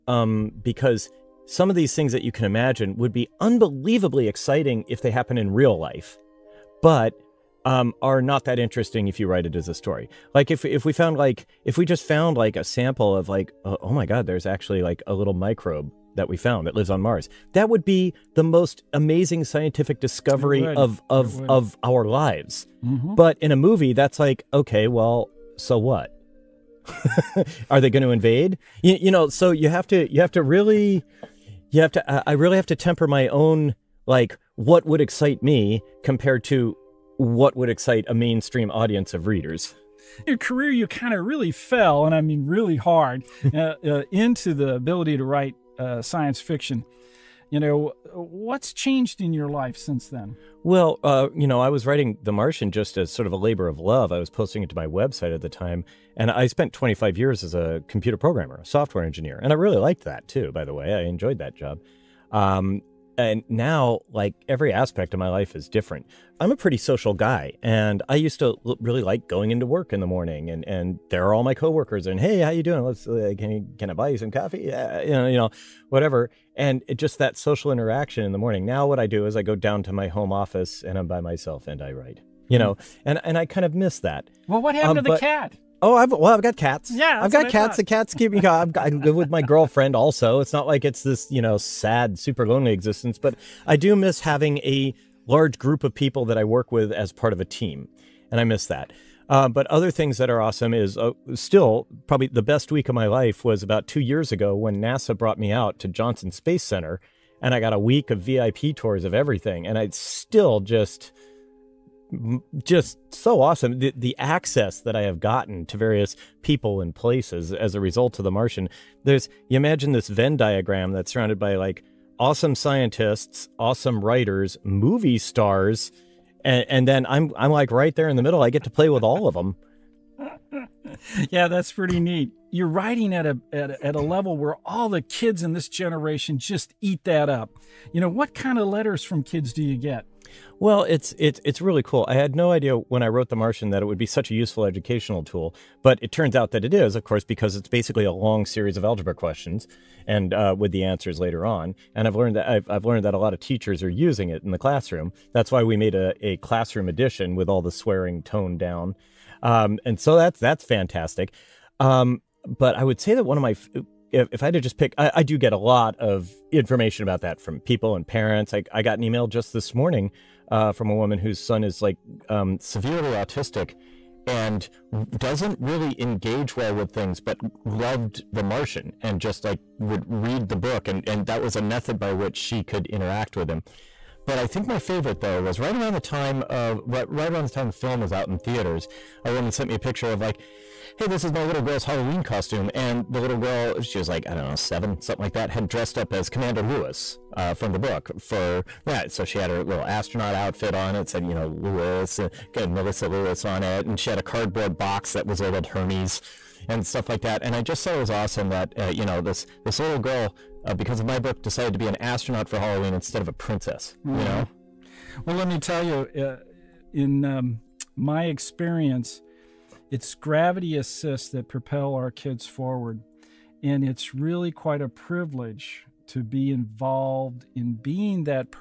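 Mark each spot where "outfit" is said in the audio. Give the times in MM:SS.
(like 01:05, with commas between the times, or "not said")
03:20.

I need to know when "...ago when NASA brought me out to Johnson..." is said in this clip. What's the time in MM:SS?
01:44.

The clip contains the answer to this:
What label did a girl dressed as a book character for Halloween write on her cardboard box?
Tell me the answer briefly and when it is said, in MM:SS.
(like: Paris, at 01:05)
Hermes, at 03:25.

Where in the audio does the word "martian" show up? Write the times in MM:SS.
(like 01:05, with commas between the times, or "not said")
00:52, 01:58, 02:23, 02:58.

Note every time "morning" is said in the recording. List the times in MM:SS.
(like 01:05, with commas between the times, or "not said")
01:10, 01:18, 02:49.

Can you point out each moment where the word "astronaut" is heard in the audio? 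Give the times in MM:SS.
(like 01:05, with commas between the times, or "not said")
03:19, 03:31.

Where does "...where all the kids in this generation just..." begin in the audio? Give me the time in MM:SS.
02:14.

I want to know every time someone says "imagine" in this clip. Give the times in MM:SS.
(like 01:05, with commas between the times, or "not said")
00:02, 01:59.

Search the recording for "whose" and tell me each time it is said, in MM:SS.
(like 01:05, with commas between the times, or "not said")
02:51.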